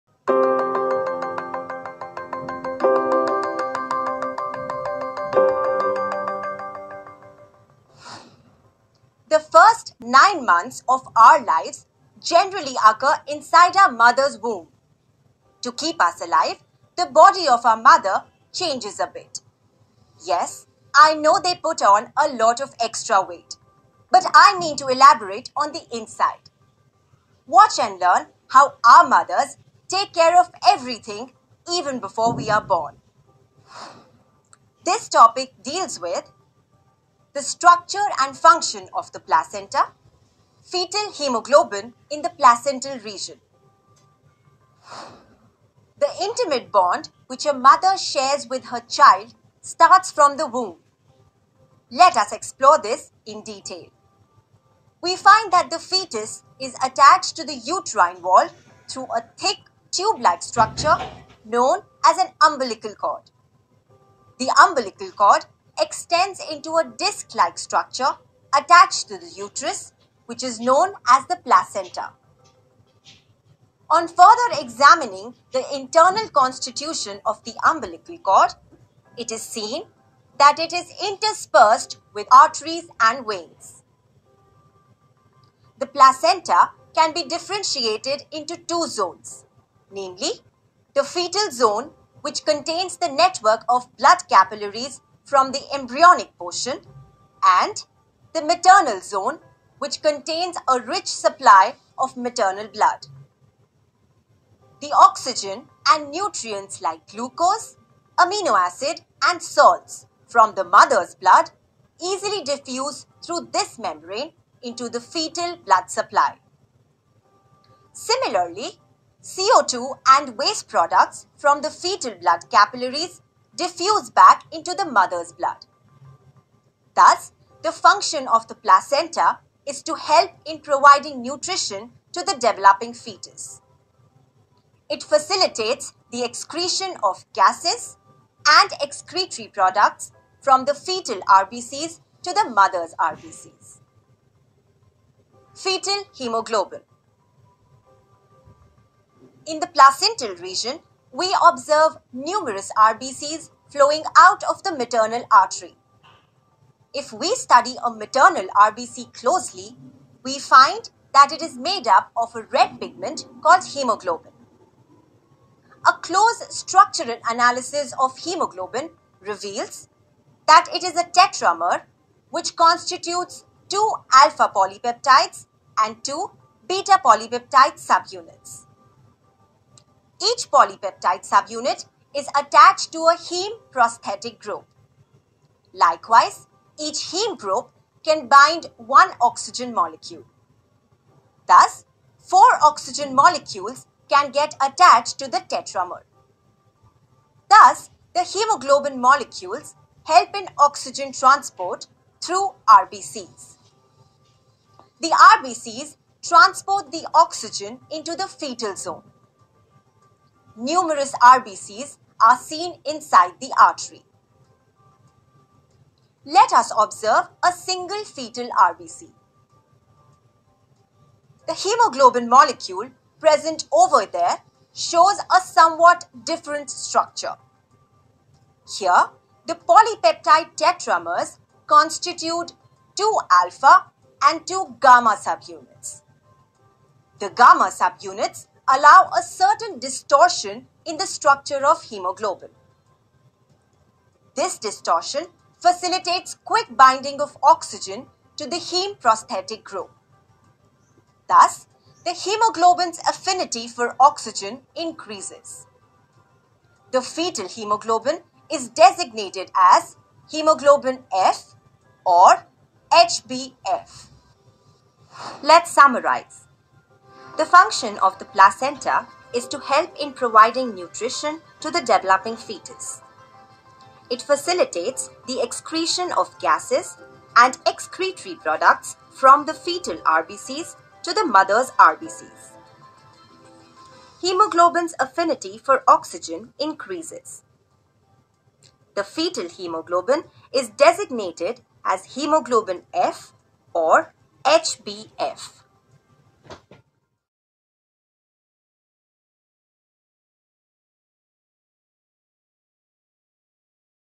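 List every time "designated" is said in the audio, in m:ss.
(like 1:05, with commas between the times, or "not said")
4:18, 4:50.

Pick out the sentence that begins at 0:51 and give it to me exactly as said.
Let us explore this in detail.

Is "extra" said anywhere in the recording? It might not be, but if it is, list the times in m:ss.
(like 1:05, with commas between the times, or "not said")
0:22.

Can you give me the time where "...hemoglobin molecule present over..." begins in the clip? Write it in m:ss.
3:41.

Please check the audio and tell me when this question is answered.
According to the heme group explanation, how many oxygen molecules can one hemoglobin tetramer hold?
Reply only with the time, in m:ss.
3:12.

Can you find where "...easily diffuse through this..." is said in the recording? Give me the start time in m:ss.
1:52.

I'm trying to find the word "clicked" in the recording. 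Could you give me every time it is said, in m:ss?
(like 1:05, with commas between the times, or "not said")
not said.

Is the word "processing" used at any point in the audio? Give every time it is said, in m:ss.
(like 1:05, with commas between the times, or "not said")
not said.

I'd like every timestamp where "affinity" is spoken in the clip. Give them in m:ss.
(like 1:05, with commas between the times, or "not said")
4:13, 4:44.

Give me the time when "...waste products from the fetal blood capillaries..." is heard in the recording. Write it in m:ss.
2:00.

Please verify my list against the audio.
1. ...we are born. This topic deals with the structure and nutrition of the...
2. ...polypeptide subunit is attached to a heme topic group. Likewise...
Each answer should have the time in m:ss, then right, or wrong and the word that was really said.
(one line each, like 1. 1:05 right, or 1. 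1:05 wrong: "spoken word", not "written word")
1. 0:32 wrong: "function", not "nutrition"
2. 3:00 wrong: "prosthetic", not "topic".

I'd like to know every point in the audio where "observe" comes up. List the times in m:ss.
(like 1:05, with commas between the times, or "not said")
2:31, 3:36.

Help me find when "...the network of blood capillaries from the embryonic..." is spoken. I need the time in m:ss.
1:32.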